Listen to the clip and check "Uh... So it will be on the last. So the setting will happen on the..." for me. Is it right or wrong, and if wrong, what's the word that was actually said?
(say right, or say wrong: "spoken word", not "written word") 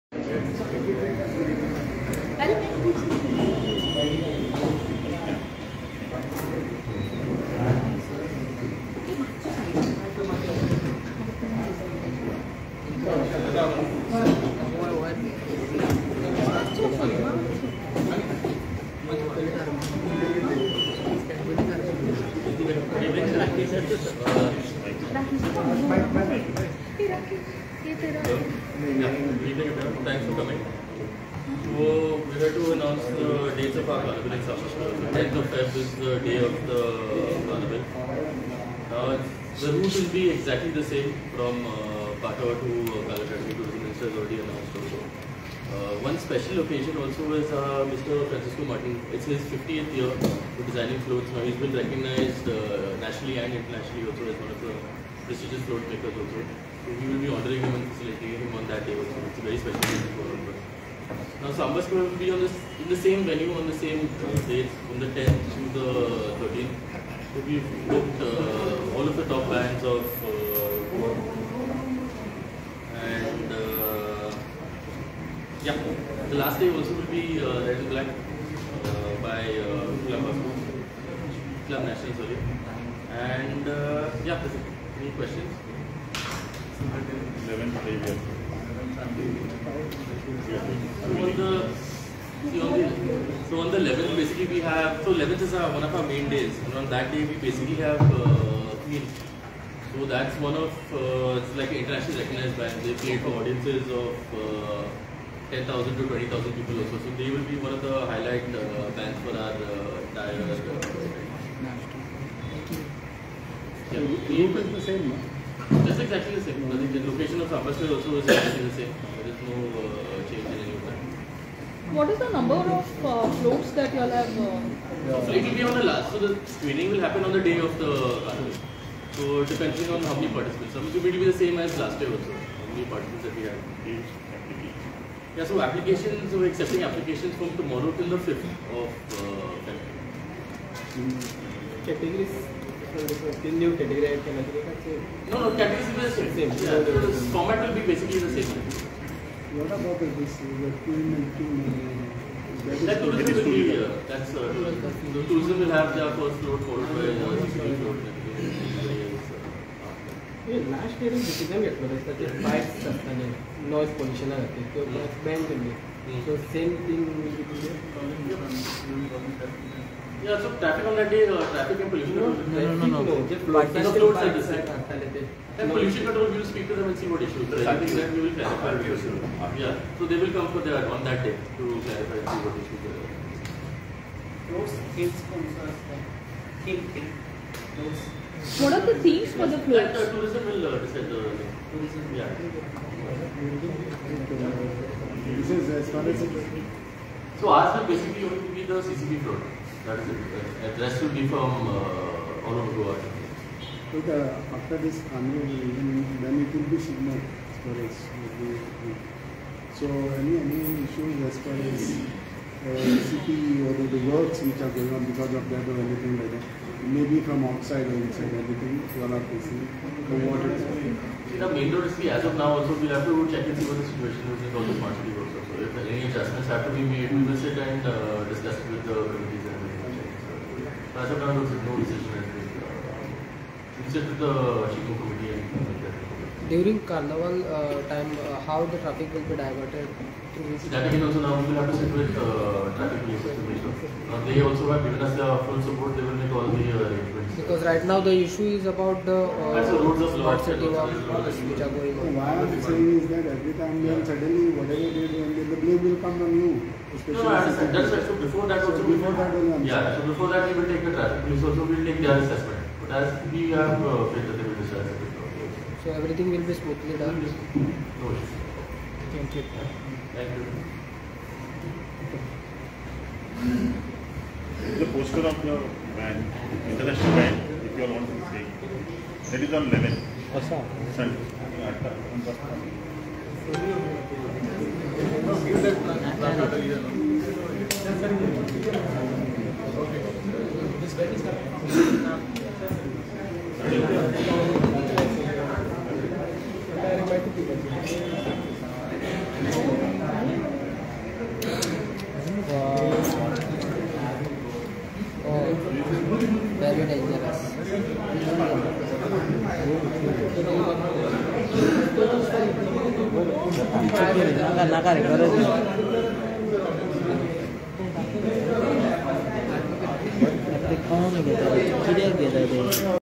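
wrong: "screening", not "setting".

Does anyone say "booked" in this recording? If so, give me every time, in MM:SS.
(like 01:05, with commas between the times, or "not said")
01:07.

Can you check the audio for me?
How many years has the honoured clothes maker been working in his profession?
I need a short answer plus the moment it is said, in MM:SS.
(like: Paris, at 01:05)
50th, at 00:49.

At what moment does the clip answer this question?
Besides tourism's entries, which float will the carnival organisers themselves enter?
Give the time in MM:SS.
03:18.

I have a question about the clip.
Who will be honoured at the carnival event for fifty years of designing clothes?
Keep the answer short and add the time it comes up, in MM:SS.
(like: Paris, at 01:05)
Francisco Martin, at 00:48.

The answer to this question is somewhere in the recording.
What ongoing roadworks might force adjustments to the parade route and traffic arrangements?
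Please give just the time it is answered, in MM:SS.
03:44.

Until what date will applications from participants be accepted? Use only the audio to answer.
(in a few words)
5th of February.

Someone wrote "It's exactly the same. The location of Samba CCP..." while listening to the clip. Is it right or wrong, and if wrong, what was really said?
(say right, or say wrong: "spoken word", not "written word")
wrong: "Square", not "CCP".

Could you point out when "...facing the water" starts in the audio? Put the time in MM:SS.
03:39.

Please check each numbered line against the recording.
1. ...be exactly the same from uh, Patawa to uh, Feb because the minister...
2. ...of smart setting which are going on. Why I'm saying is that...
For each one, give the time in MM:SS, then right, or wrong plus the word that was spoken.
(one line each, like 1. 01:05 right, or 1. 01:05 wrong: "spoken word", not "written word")
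1. 00:40 wrong: "Calcutta", not "Feb"
2. 04:10 right.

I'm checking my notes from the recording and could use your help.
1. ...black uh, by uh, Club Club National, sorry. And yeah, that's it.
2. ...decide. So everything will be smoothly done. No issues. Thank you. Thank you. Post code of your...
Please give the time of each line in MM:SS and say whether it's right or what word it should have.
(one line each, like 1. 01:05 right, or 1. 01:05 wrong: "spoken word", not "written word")
1. 01:17 right
2. 04:24 right.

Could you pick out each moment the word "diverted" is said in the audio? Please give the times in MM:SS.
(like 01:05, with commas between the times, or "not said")
03:59.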